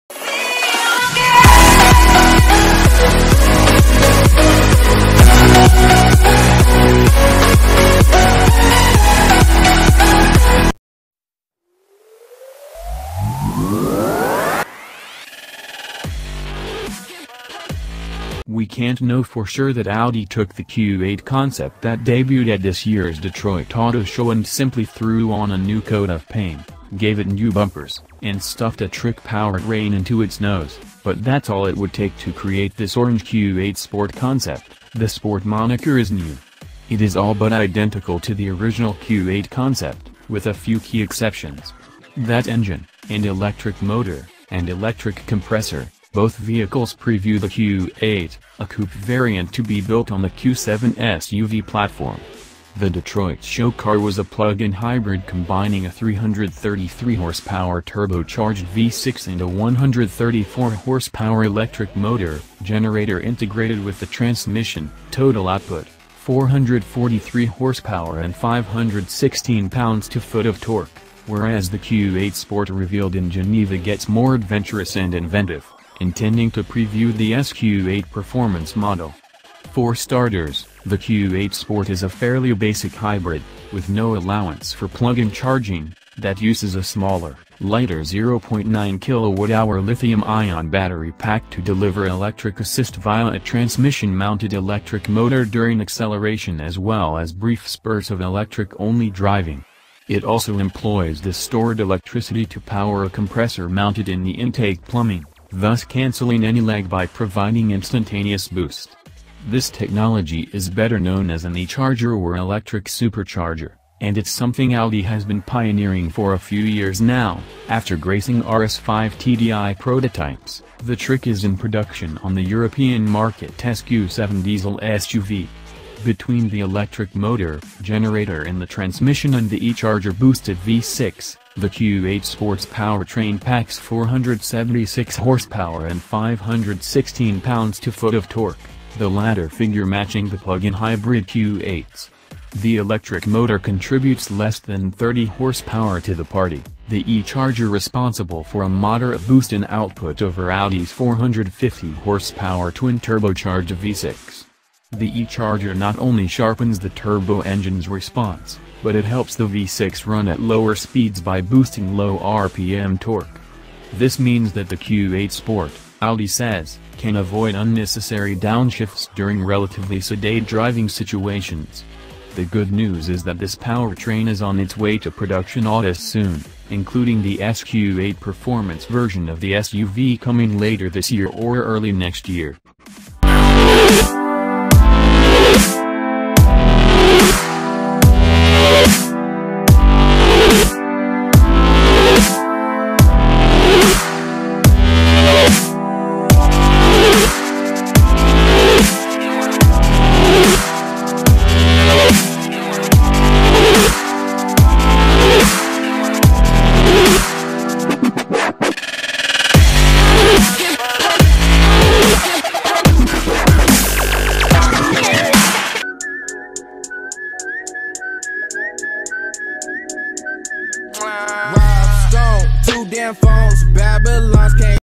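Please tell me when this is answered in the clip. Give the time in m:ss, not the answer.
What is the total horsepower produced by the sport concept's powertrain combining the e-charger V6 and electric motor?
2:13.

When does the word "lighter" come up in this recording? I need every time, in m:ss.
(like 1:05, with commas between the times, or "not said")
1:27.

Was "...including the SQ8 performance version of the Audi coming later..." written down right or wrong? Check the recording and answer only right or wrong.
wrong.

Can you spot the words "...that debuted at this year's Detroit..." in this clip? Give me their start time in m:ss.
0:21.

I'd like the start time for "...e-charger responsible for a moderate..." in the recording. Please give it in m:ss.
2:27.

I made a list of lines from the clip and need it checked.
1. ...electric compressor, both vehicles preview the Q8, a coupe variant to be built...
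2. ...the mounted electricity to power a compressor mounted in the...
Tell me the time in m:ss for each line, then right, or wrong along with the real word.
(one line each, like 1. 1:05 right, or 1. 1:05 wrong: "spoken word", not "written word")
1. 0:44 right
2. 1:41 wrong: "stored", not "mounted".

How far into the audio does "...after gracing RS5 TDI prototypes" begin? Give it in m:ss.
1:57.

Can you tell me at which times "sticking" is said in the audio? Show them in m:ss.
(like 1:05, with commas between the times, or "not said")
not said.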